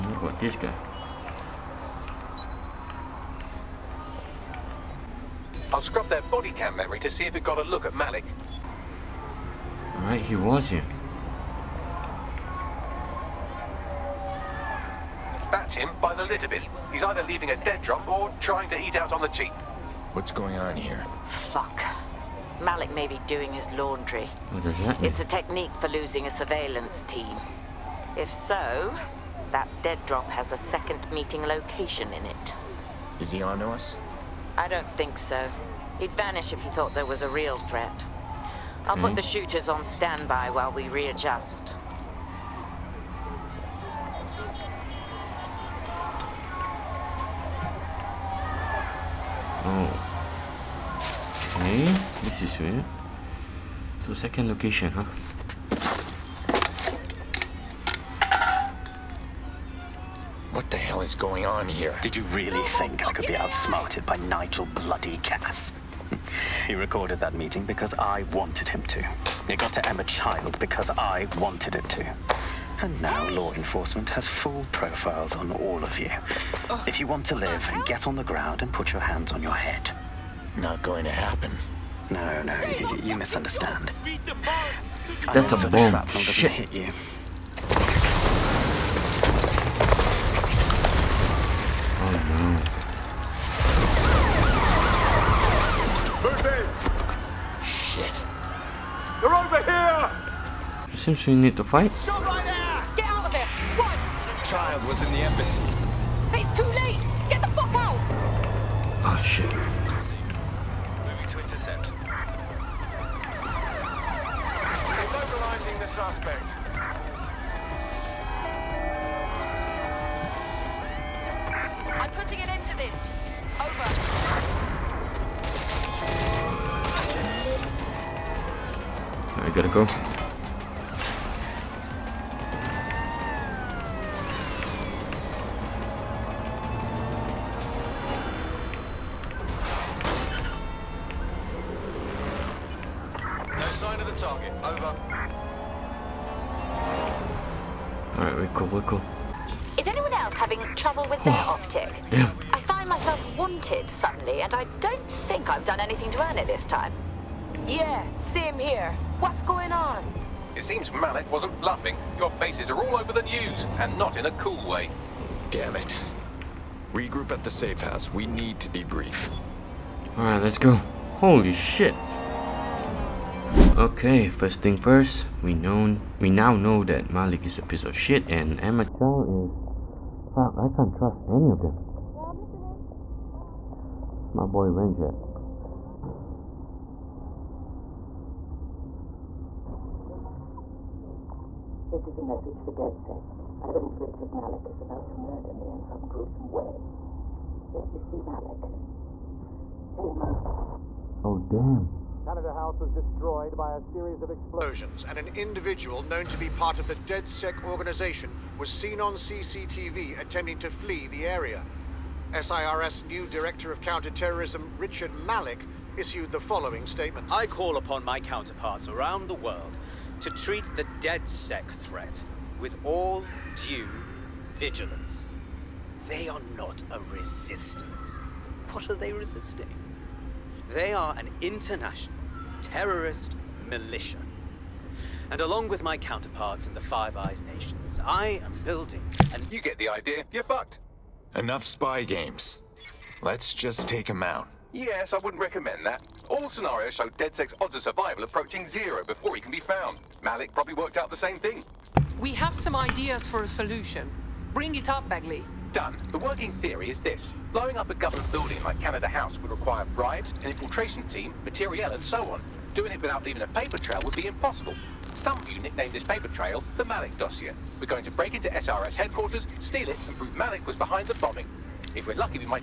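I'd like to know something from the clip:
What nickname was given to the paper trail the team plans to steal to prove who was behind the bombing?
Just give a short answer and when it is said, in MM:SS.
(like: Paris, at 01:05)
The Malik dossier, at 04:26.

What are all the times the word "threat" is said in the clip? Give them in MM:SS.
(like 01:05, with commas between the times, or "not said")
00:37, 03:41.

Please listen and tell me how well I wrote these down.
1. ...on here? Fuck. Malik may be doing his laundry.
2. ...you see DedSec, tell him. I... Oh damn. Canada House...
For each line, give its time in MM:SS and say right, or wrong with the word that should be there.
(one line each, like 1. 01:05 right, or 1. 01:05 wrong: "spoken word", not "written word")
1. 00:20 right
2. 03:17 wrong: "Malik", not "DedSec".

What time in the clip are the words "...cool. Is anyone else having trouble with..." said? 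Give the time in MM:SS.
02:28.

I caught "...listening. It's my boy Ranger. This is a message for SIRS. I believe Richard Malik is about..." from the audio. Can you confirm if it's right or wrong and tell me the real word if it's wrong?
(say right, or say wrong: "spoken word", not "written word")
wrong: "DedSec", not "SIRS".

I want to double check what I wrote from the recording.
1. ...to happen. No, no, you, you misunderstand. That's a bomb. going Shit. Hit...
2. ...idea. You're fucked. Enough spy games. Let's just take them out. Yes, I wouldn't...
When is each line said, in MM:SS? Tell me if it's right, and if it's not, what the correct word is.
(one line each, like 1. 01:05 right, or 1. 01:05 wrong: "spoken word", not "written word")
1. 01:21 right
2. 03:59 right.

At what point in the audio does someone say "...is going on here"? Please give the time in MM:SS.
01:00.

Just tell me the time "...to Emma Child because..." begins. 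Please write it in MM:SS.
01:09.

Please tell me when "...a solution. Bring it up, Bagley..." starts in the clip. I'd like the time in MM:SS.
04:13.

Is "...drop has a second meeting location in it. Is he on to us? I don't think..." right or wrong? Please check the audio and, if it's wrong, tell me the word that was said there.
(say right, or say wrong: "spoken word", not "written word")
right.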